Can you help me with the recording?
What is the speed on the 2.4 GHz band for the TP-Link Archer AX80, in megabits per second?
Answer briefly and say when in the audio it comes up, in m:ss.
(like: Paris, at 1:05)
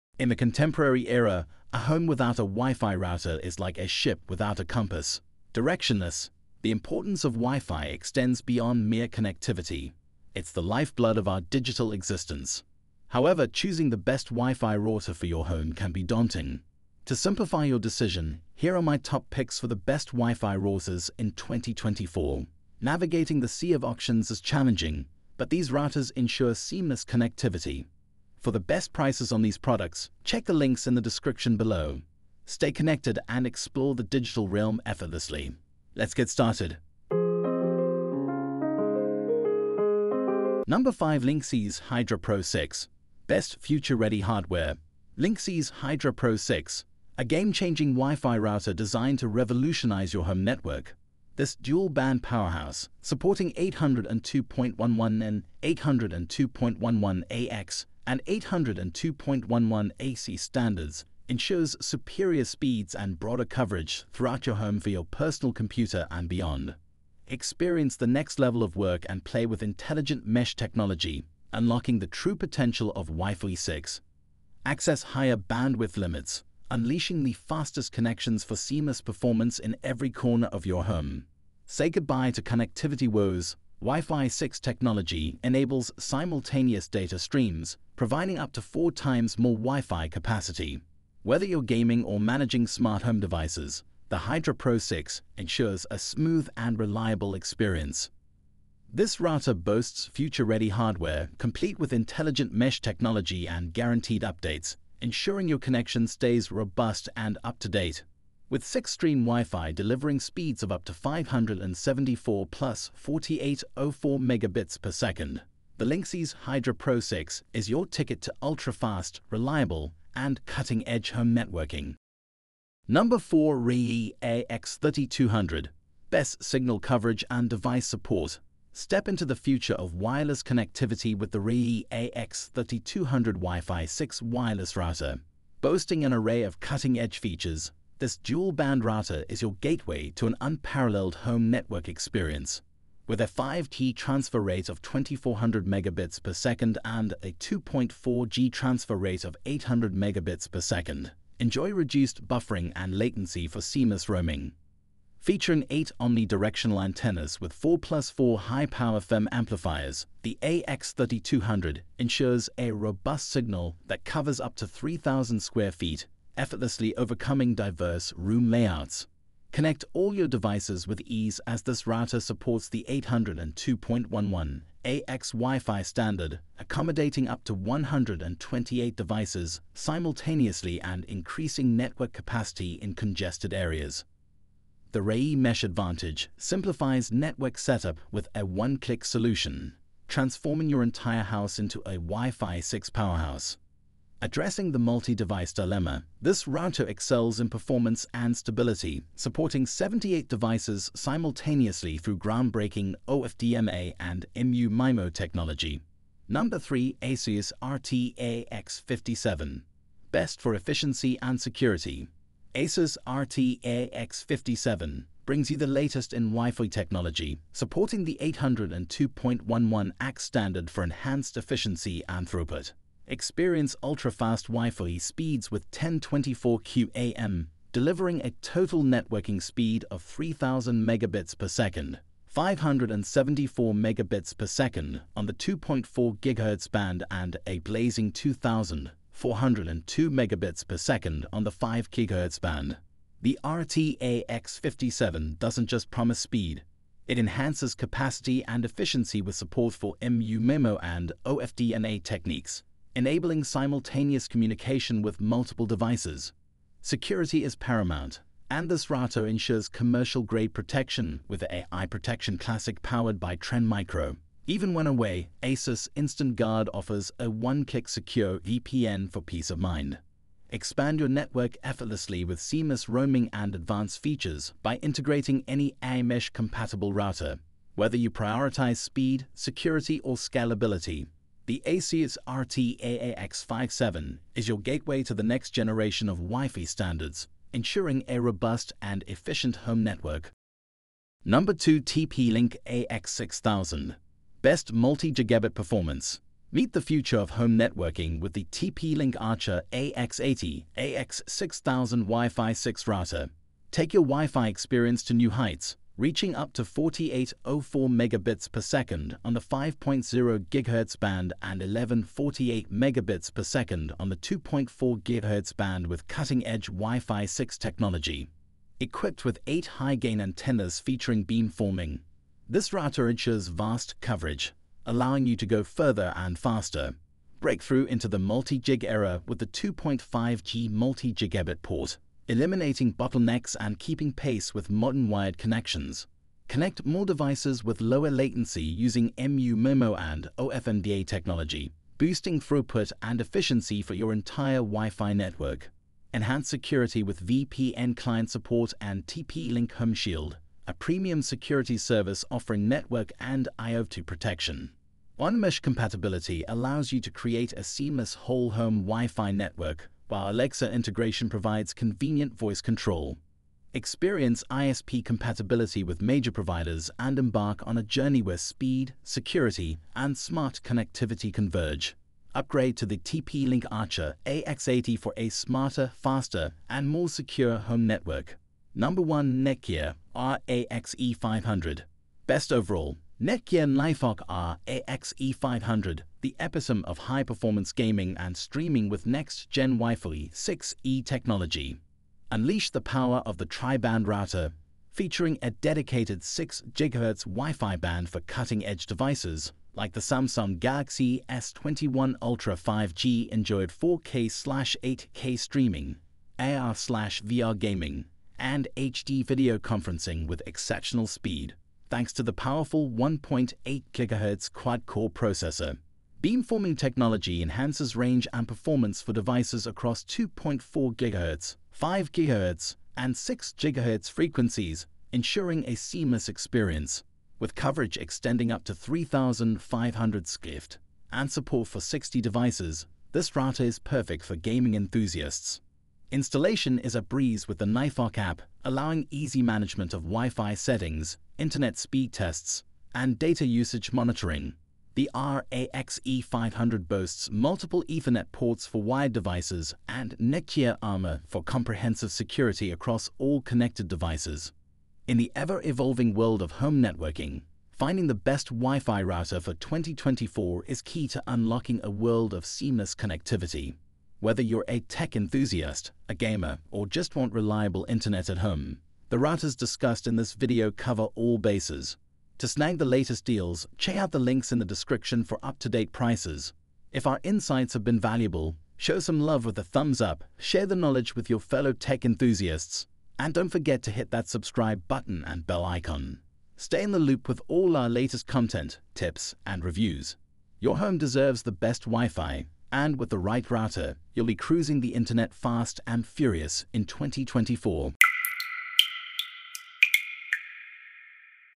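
1148, at 5:11.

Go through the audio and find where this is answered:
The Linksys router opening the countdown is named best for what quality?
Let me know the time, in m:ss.
0:43.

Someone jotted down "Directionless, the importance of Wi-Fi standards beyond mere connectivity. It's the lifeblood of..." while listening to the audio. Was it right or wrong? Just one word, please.
wrong.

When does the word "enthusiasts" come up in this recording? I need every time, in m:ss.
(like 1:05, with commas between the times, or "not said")
7:14, 7:45, 8:02.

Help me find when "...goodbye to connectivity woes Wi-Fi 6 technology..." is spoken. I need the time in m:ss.
1:21.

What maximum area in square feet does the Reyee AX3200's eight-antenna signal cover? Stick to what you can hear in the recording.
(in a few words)
3,000 square feet.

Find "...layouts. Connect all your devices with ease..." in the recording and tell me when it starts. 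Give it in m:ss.
2:48.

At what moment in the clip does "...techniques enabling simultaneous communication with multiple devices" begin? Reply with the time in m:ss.
4:12.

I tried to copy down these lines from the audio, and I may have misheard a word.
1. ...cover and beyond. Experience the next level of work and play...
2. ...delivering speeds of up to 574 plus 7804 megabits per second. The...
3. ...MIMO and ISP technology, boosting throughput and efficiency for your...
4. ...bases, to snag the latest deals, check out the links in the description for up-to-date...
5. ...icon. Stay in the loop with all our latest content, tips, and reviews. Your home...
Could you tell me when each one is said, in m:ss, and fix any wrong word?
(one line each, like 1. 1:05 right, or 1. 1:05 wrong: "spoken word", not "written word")
1. 1:05 wrong: "computer", not "cover"
2. 1:49 wrong: "4804", not "7804"
3. 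5:39 wrong: "OFDMA", not "ISP"
4. 7:51 right
5. 8:05 right.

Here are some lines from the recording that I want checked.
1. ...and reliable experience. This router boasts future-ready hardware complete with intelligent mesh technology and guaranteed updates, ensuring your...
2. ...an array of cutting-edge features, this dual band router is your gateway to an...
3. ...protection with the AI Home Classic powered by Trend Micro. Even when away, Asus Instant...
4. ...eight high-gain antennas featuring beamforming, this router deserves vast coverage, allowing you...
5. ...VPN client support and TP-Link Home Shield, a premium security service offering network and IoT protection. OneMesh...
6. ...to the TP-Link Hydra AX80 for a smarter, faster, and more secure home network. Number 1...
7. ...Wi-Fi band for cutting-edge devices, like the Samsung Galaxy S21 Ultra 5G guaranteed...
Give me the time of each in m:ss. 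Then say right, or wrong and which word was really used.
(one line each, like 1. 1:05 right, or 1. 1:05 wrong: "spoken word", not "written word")
1. 1:36 right
2. 2:16 right
3. 4:20 wrong: "Protection", not "Home"
4. 5:19 wrong: "ensures", not "deserves"
5. 5:47 right
6. 6:12 wrong: "Archer", not "Hydra"
7. 6:37 wrong: "enjoyed", not "guaranteed".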